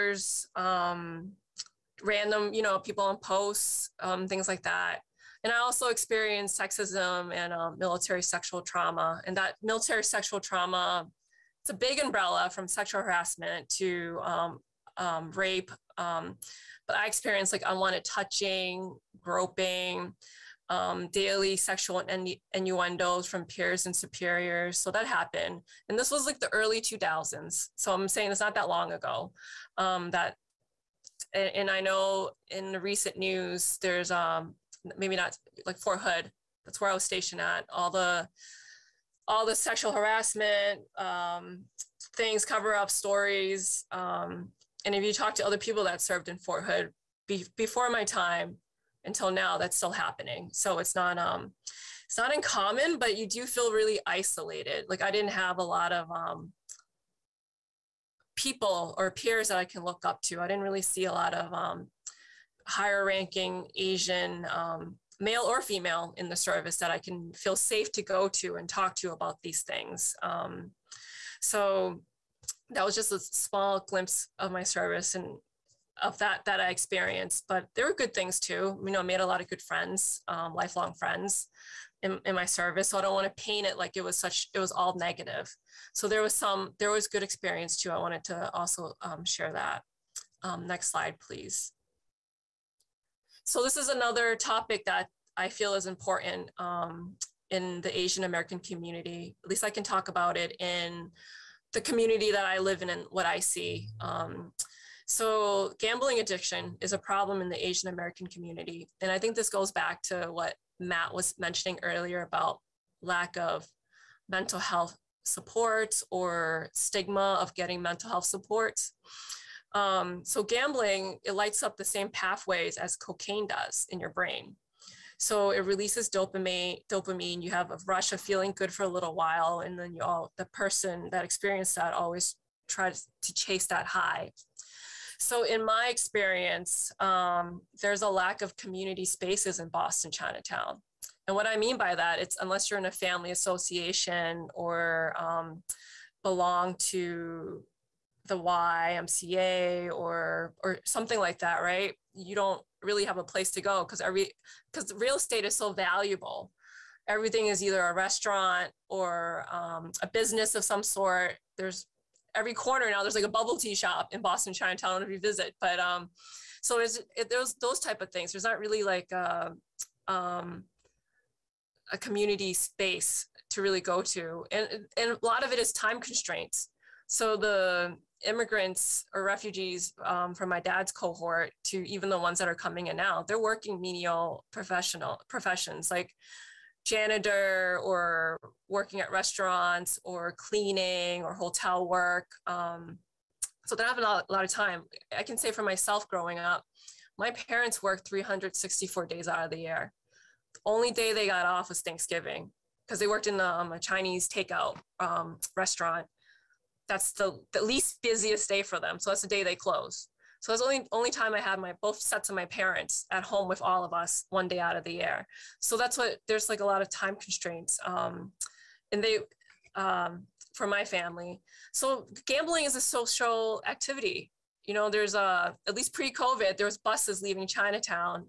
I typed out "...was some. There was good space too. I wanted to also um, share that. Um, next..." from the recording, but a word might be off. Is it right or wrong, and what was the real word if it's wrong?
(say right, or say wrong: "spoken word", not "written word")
wrong: "experience", not "space".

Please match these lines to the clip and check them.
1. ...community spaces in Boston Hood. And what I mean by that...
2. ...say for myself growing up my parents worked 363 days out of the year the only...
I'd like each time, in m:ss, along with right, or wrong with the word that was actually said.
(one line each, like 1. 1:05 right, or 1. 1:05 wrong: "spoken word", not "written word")
1. 2:18 wrong: "Chinatown", not "Hood"
2. 3:15 wrong: "364", not "363".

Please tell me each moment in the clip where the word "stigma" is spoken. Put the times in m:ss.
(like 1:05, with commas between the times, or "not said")
1:56.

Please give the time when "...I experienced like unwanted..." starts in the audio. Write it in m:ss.
0:16.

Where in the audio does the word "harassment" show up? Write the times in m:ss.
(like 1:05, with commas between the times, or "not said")
0:13, 0:39.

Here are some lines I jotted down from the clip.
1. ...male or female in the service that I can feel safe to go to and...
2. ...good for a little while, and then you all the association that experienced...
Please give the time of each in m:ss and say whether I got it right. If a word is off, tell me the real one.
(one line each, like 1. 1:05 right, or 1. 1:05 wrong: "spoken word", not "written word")
1. 1:05 right
2. 2:08 wrong: "person", not "association".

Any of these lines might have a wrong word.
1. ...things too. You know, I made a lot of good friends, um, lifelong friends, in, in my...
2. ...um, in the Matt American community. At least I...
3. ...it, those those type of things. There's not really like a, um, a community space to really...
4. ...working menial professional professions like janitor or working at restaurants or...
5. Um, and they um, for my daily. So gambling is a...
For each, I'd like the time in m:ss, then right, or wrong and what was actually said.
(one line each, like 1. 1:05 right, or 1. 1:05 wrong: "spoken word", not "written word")
1. 1:18 right
2. 1:36 wrong: "Asian", not "Matt"
3. 2:47 right
4. 3:03 right
5. 3:37 wrong: "family", not "daily".